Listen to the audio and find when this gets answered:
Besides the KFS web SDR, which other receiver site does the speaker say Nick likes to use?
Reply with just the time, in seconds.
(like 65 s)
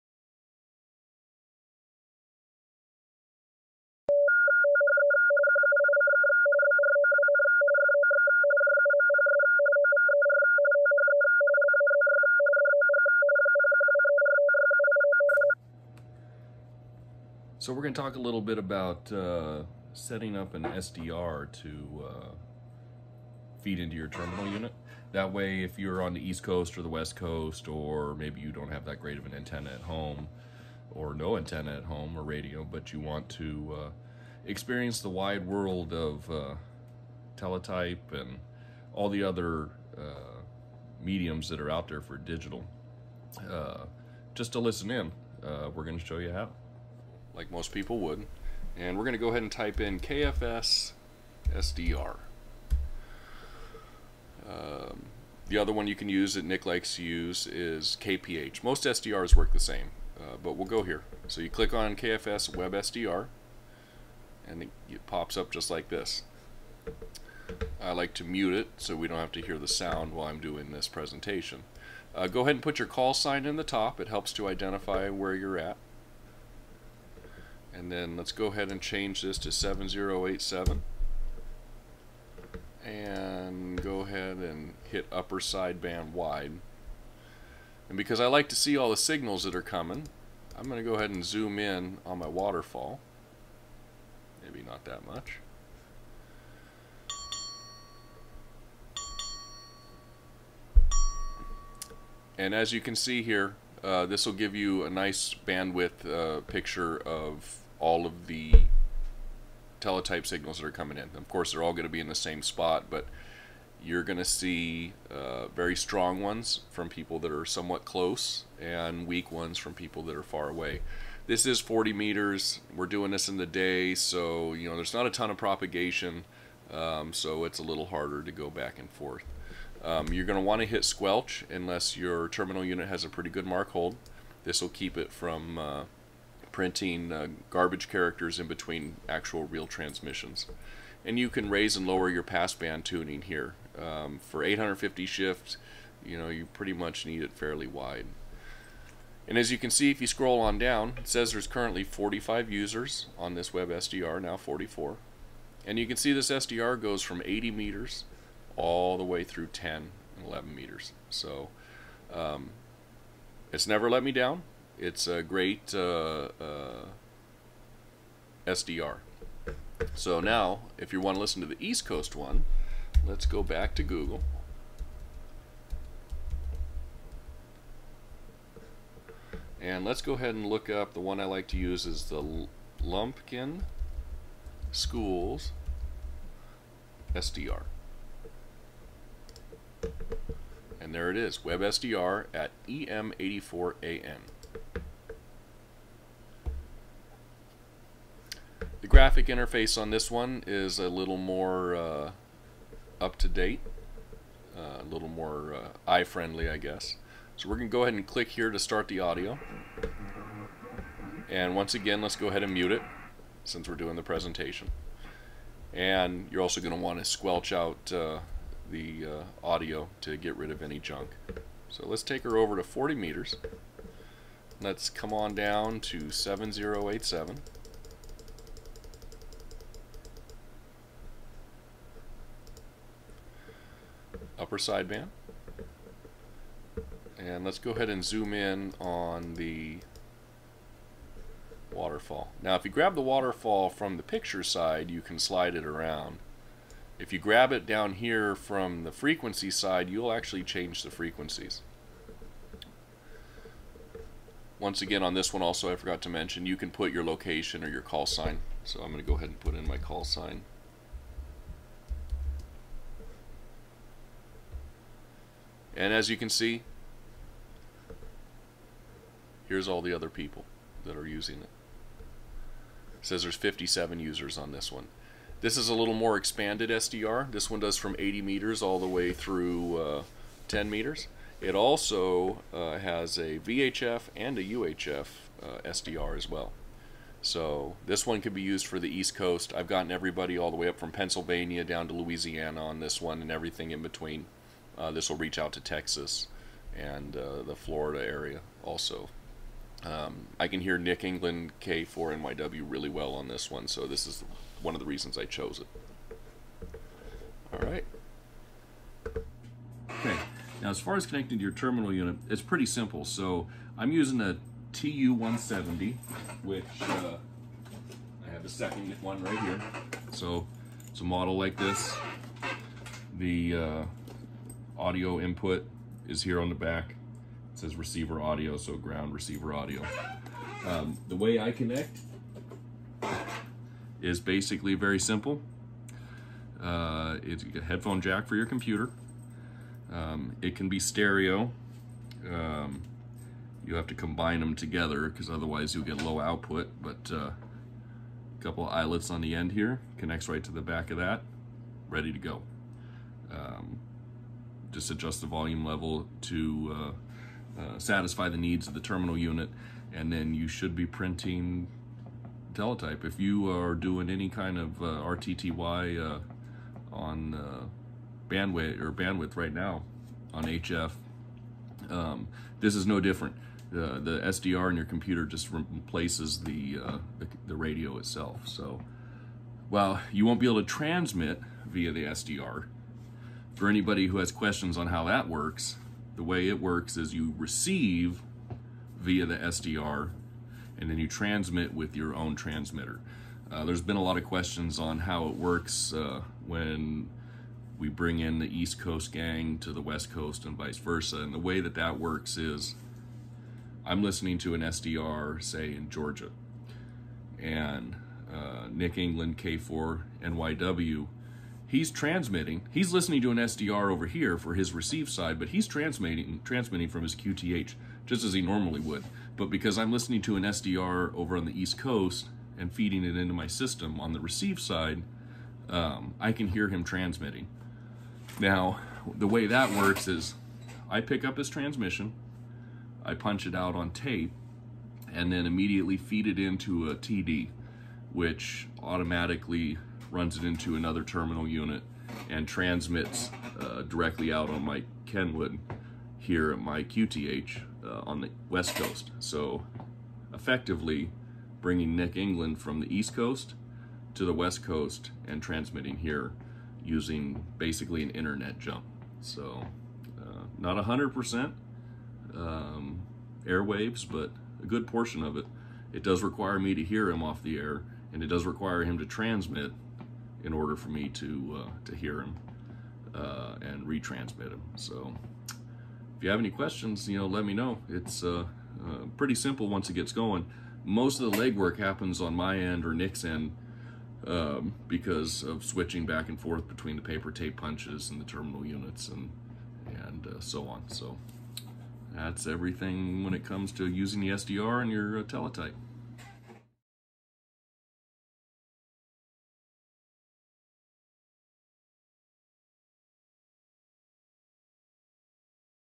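58 s.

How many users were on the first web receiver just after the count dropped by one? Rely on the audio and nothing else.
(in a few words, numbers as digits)
44.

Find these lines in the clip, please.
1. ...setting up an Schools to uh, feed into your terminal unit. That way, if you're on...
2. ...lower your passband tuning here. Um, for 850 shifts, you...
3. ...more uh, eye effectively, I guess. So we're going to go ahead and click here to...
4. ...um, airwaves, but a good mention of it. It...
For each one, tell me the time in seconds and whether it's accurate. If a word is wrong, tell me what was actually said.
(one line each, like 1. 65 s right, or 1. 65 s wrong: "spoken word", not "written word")
1. 19 s wrong: "SDR", not "Schools"
2. 141 s right
3. 205 s wrong: "friendly", not "effectively"
4. 462 s wrong: "portion", not "mention".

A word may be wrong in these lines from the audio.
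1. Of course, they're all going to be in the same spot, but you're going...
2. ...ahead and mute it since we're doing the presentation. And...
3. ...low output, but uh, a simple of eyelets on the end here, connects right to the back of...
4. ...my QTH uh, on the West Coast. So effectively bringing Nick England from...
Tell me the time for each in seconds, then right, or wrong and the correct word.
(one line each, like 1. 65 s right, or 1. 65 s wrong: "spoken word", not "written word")
1. 111 s right
2. 212 s right
3. 346 s wrong: "couple", not "simple"
4. 446 s right.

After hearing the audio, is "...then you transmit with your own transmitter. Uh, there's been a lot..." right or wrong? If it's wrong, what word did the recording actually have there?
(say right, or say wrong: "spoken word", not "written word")
right.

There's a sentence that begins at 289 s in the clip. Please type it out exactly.
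I've gotten everybody all the way up from Pennsylvania down to Louisiana on this one and everything in between.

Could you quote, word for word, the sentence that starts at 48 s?
And we're going to go ahead and type in KFS SDR.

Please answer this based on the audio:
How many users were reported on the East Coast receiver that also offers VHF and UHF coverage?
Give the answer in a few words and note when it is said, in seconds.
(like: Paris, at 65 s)
57, at 273 s.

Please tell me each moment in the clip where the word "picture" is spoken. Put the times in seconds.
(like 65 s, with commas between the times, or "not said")
106 s, 244 s.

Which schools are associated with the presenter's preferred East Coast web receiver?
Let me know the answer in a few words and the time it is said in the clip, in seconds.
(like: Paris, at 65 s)
Lumpkin Schools, at 182 s.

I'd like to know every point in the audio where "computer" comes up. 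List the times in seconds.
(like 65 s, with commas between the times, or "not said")
338 s, 374 s.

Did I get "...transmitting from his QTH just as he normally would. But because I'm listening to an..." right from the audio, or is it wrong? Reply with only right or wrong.
right.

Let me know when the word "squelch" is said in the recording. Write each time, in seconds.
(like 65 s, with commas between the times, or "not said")
130 s, 217 s.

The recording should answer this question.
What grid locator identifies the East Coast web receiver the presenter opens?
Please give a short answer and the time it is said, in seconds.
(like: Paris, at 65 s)
EM84AN, at 192 s.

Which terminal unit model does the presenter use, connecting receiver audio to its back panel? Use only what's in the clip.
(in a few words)
TU-170.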